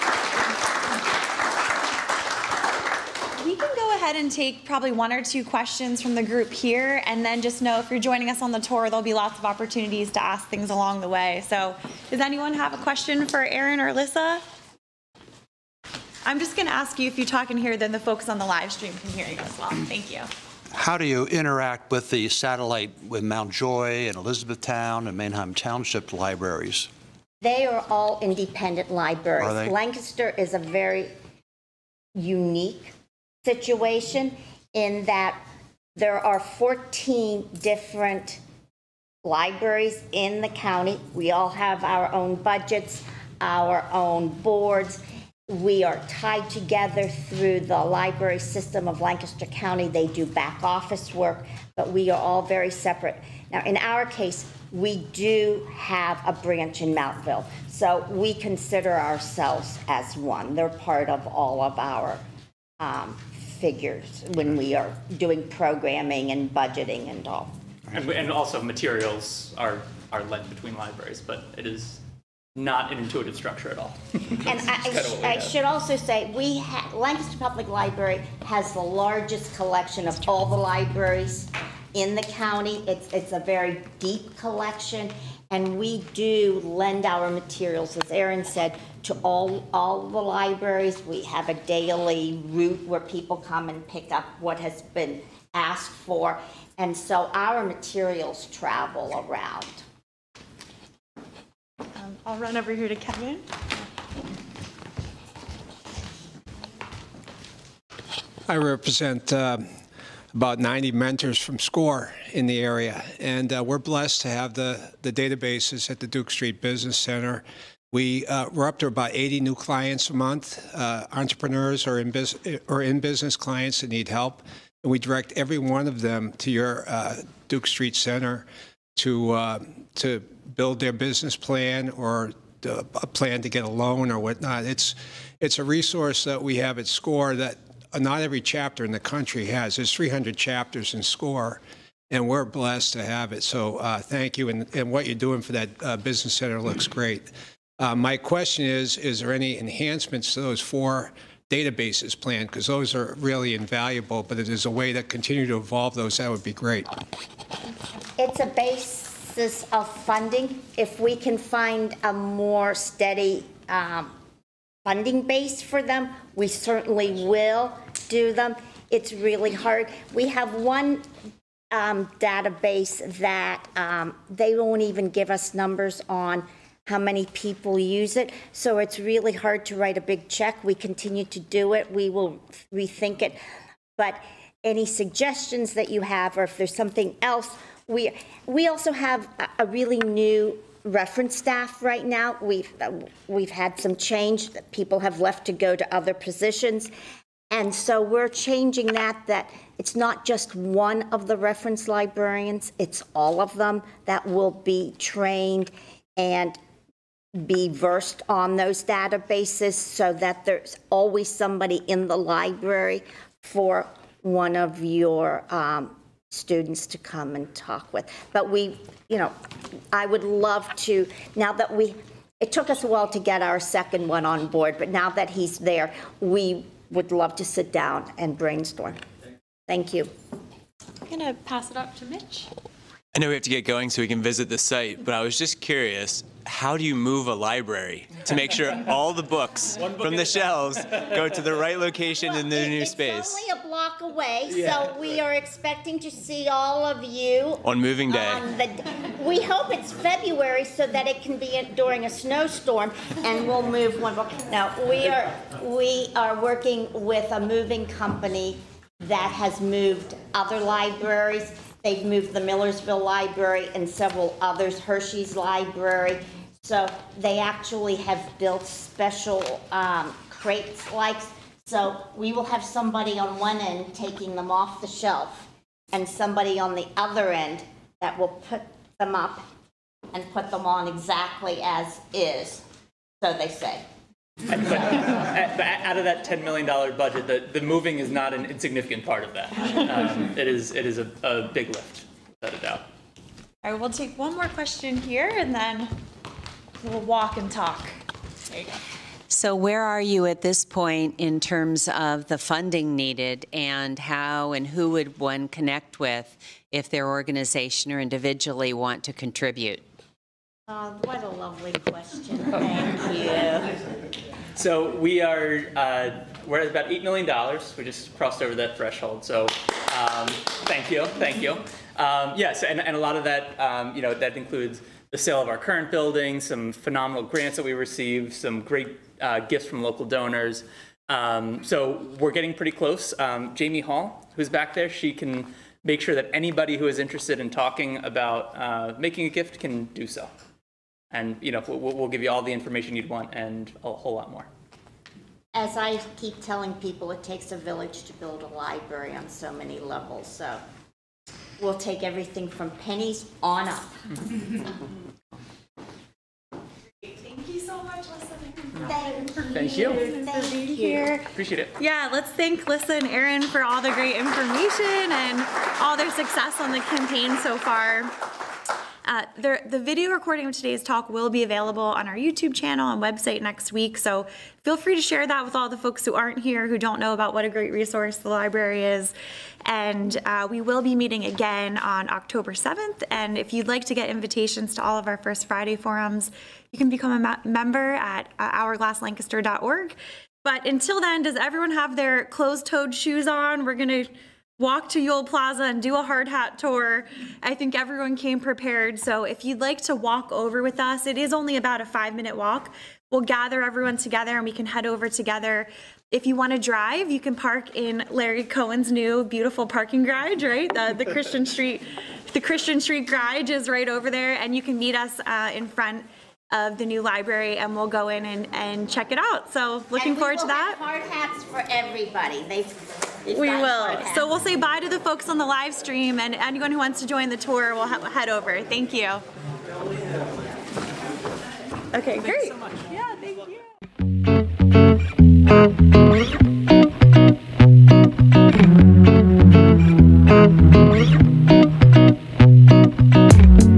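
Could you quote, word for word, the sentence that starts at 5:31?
Um, so we're getting pretty close.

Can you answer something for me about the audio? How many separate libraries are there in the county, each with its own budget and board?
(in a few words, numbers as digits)
14.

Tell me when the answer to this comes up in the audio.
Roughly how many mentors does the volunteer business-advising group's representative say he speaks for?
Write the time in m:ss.
1:50.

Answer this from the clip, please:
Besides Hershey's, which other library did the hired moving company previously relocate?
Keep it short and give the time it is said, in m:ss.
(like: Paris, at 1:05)
Millersville Library, at 4:22.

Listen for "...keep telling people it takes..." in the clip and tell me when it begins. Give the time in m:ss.
5:46.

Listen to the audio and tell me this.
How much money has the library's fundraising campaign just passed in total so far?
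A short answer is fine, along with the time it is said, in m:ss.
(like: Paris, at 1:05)
$8 million, at 5:16.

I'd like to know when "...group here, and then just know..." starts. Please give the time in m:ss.
0:06.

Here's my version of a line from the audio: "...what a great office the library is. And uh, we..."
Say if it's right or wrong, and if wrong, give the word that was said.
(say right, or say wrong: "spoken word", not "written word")
wrong: "resource", not "office".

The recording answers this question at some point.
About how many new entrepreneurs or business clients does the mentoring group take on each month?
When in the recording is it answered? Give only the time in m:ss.
1:59.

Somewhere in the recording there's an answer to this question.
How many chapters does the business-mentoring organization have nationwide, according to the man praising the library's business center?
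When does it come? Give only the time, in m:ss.
2:19.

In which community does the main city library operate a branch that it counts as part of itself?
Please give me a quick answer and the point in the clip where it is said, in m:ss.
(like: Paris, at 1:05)
Mountville, at 0:56.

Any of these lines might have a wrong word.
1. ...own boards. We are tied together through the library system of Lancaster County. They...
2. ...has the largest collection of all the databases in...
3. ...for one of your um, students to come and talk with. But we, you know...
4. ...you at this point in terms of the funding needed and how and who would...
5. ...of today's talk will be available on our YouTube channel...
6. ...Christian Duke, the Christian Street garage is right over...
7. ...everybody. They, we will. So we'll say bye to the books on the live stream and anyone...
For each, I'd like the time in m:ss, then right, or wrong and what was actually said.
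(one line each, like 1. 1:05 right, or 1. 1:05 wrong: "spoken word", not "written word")
1. 0:43 right
2. 1:18 wrong: "libraries", not "databases"
3. 3:33 right
4. 4:59 right
5. 6:10 right
6. 6:51 wrong: "Street", not "Duke"
7. 7:01 wrong: "folks", not "books".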